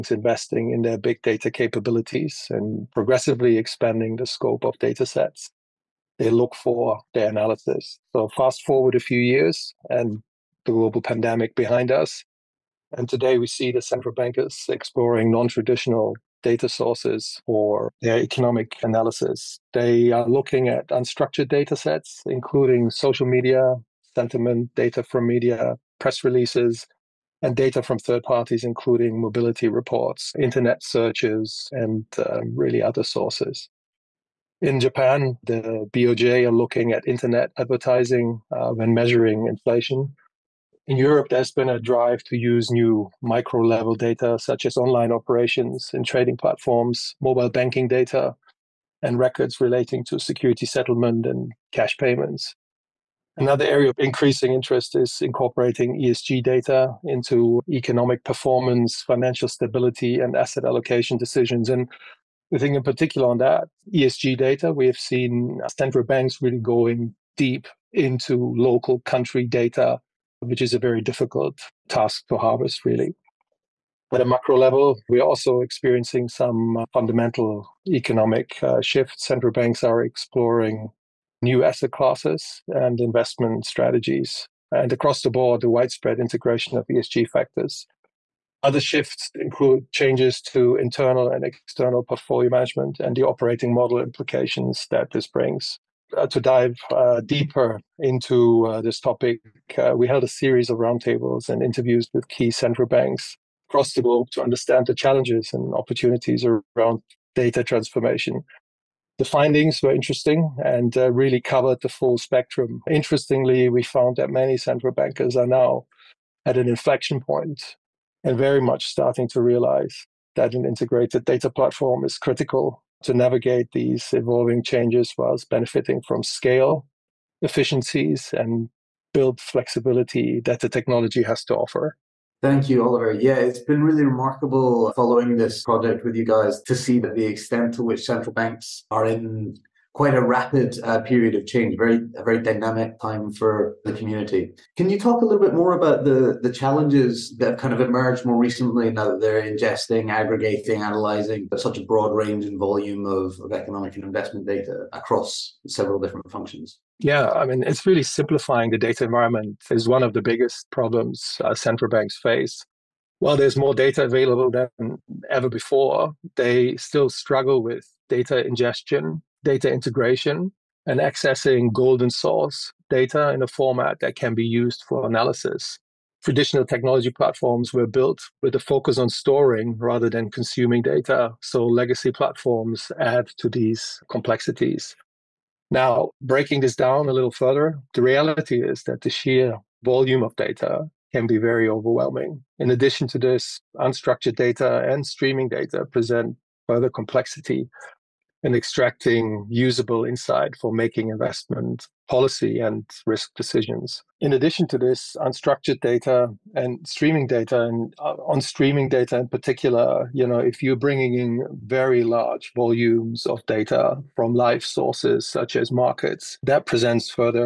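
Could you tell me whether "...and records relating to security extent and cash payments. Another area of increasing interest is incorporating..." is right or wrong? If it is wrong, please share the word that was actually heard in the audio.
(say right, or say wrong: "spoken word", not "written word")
wrong: "settlement", not "extent".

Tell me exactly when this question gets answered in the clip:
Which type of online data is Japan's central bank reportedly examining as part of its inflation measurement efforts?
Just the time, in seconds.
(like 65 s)
37 s.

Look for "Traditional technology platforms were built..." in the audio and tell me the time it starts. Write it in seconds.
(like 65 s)
176 s.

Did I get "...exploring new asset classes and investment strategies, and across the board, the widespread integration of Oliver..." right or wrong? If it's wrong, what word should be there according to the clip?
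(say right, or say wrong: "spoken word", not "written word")
wrong: "ESG", not "Oliver".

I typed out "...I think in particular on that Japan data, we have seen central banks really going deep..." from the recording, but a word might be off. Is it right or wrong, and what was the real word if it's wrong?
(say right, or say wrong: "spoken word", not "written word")
wrong: "ESG", not "Japan".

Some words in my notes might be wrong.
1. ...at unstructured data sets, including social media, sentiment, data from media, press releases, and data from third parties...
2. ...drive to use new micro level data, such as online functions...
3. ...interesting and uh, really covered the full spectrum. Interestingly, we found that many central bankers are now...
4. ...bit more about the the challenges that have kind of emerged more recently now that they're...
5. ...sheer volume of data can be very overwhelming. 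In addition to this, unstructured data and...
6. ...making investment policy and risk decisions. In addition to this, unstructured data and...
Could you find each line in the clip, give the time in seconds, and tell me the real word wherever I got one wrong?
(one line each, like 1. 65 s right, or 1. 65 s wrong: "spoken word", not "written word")
1. 20 s right
2. 41 s wrong: "operations", not "functions"
3. 109 s right
4. 145 s right
5. 189 s right
6. 200 s right.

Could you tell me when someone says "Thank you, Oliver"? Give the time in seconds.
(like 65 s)
132 s.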